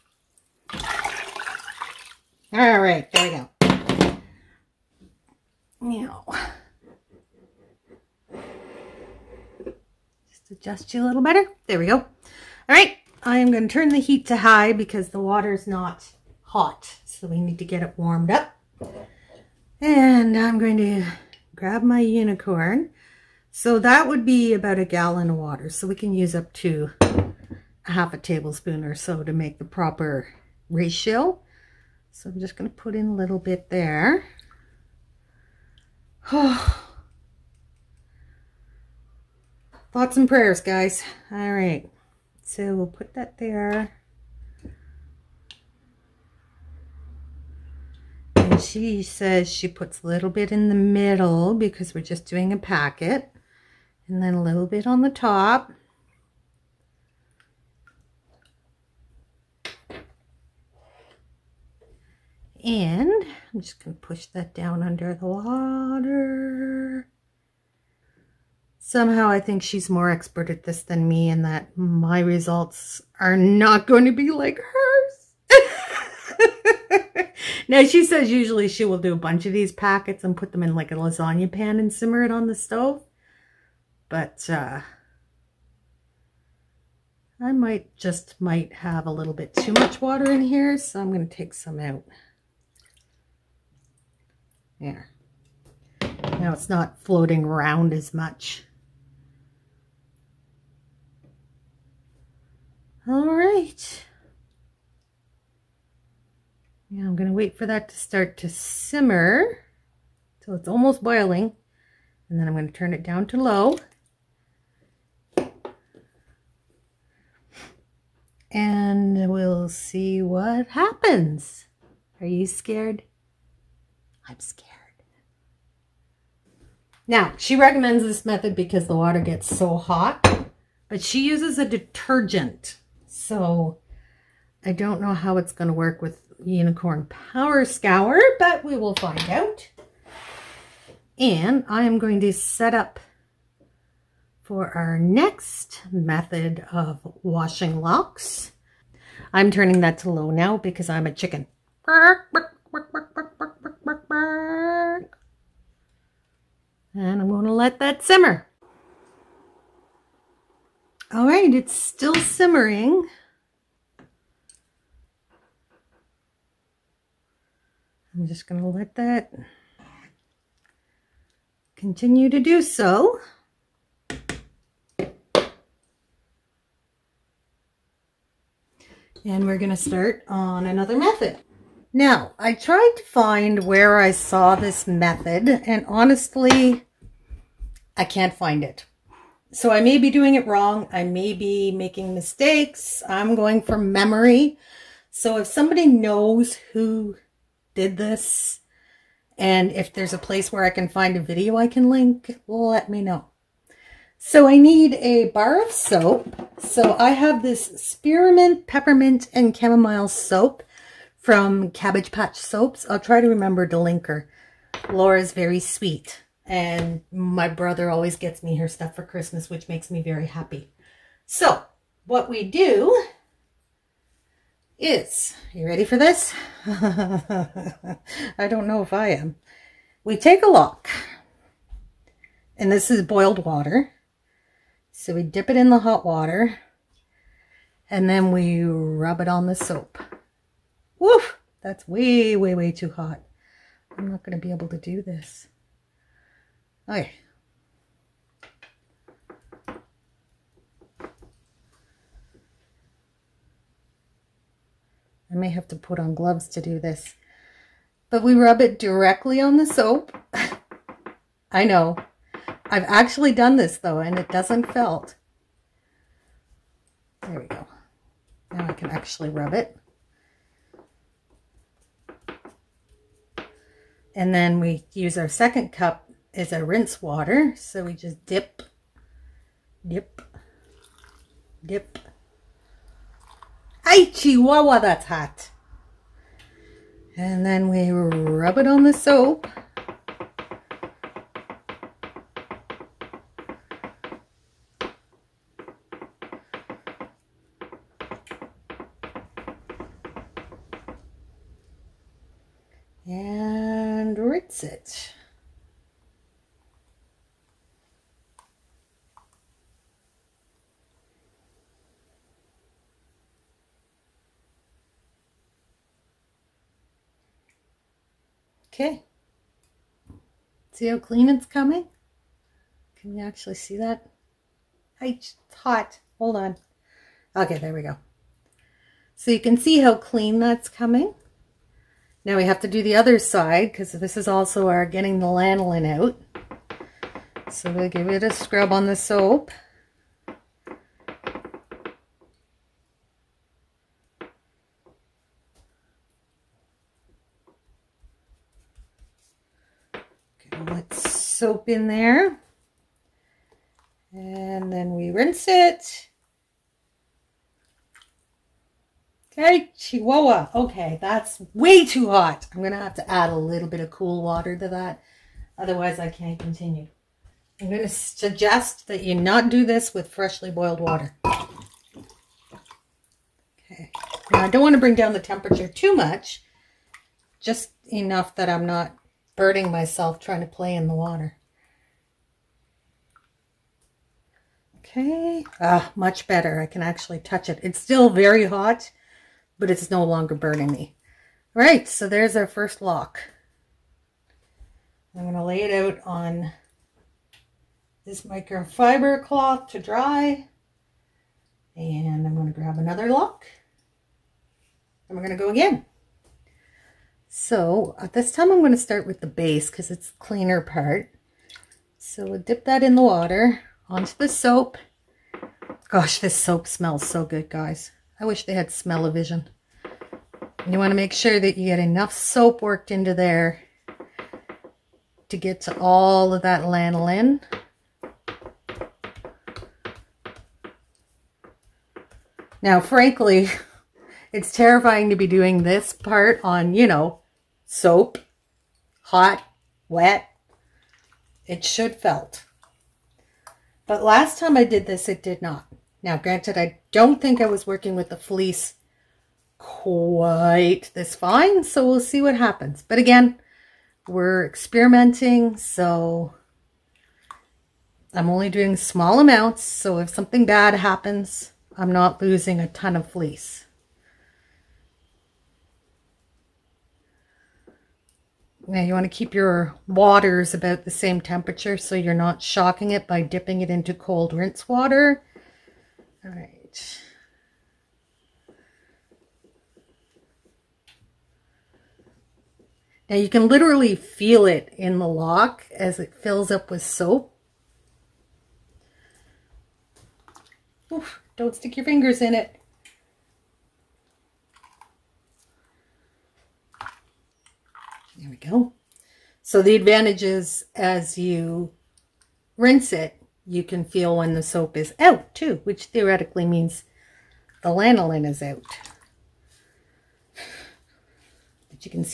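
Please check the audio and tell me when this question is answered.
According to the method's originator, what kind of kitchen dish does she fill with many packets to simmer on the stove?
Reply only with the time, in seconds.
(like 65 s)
80 s.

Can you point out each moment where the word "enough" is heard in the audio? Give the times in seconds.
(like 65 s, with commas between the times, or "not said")
377 s, 421 s.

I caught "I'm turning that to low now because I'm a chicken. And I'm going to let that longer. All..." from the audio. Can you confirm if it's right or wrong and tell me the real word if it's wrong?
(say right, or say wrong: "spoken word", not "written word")
wrong: "simmer", not "longer".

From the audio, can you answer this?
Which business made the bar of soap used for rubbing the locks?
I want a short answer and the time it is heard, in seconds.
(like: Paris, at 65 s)
Cabbage Patch Soaps, at 211 s.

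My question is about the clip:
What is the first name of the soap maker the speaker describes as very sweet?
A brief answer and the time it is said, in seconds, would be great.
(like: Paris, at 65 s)
Laura, at 214 s.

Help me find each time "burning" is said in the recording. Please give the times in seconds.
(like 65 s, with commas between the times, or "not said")
379 s, 390 s.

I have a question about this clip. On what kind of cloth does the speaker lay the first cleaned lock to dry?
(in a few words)
microfiber cloth.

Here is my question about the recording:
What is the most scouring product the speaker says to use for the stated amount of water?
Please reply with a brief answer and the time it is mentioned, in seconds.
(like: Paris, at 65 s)
half a tablespoon, at 27 s.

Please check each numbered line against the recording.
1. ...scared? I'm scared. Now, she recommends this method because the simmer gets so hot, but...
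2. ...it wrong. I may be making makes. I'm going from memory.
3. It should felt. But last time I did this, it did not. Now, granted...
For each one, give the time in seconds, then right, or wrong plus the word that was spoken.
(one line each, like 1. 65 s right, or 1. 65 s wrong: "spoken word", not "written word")
1. 122 s wrong: "water", not "simmer"
2. 190 s wrong: "mistakes", not "makes"
3. 441 s right.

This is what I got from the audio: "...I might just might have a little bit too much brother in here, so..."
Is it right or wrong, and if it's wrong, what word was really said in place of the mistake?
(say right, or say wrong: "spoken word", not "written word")
wrong: "water", not "brother".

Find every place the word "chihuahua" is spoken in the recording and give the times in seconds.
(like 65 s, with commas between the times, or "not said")
284 s, 359 s.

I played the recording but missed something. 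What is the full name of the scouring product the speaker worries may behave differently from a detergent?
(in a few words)
Unicorn Power Scour.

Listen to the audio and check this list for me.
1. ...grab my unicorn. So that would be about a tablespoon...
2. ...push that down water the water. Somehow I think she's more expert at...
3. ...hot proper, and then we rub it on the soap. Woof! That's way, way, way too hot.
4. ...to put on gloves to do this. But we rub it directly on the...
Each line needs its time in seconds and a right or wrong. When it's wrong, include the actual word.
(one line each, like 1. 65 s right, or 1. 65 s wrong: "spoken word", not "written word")
1. 21 s wrong: "gallon", not "tablespoon"
2. 63 s wrong: "under", not "water"
3. 235 s wrong: "water", not "proper"
4. 255 s right.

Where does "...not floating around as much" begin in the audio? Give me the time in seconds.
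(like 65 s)
96 s.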